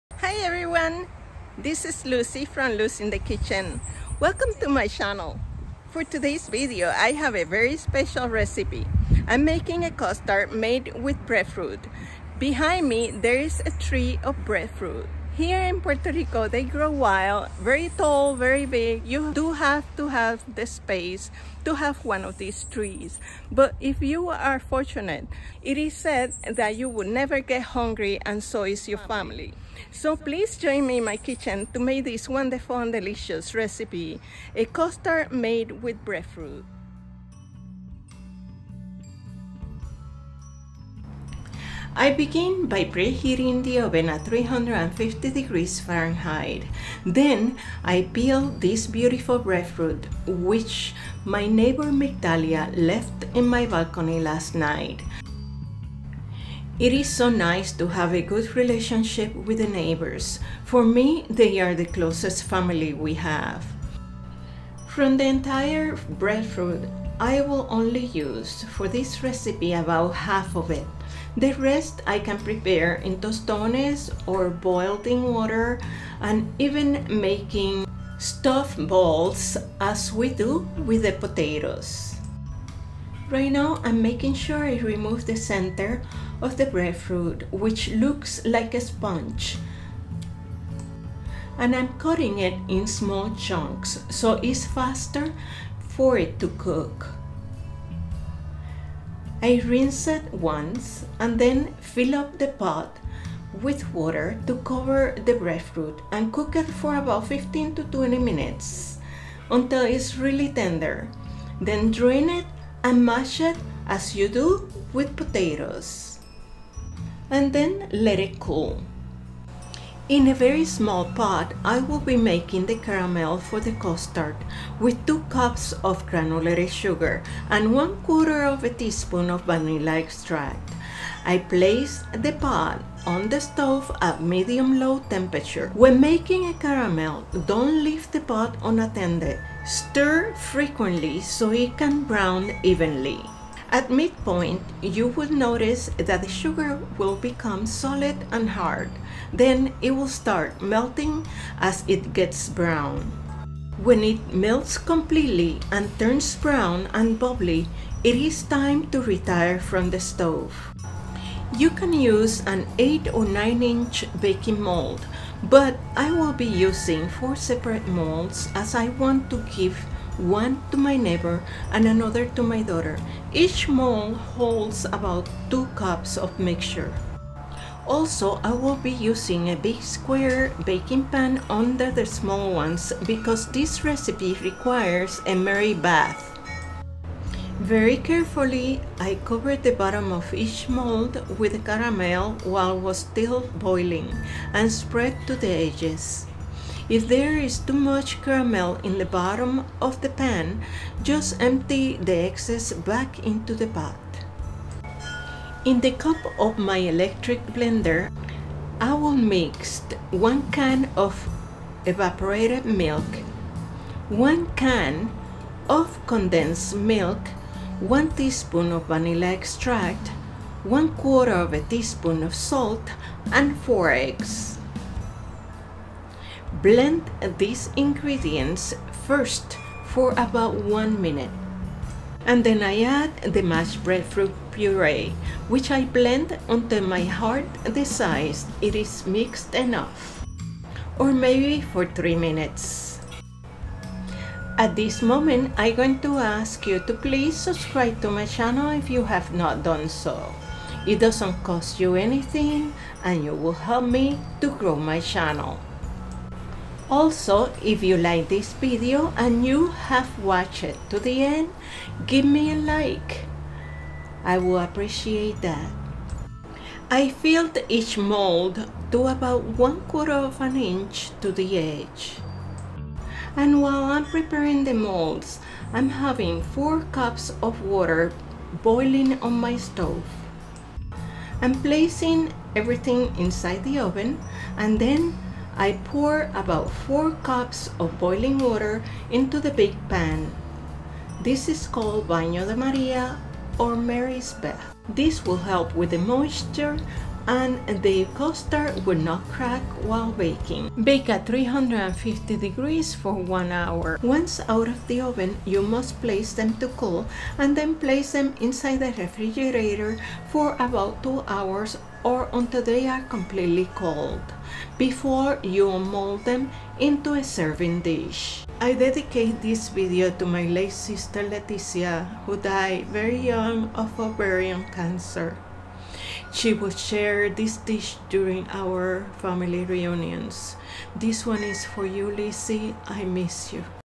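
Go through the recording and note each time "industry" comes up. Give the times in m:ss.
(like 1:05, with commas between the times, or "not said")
not said.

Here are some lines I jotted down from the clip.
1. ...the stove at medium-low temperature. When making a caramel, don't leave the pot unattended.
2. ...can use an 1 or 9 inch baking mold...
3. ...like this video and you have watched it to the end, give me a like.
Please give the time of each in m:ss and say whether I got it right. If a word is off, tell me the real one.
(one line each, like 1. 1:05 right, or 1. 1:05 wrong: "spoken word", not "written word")
1. 2:13 right
2. 2:41 wrong: "8", not "1"
3. 4:17 right.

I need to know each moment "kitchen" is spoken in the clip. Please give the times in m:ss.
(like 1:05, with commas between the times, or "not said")
0:03, 0:31.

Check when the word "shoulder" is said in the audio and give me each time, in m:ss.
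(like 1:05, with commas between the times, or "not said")
not said.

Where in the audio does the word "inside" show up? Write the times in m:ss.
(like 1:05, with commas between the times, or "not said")
4:43, 5:08.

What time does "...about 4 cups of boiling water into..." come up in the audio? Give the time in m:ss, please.
4:46.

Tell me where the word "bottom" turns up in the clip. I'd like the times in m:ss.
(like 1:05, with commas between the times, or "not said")
3:09, 3:19.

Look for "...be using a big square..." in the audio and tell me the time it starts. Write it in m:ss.
2:58.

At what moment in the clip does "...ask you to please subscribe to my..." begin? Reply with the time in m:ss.
4:06.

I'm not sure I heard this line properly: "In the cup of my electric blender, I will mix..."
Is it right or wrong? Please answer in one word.
right.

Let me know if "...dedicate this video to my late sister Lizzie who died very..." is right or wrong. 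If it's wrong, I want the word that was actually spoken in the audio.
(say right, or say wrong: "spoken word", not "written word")
wrong: "Leticia", not "Lizzie".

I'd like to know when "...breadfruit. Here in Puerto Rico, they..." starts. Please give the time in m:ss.
0:14.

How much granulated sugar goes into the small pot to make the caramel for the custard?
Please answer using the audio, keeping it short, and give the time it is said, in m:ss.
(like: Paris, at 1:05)
2 cups, at 2:05.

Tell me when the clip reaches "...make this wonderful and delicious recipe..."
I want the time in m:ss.
0:31.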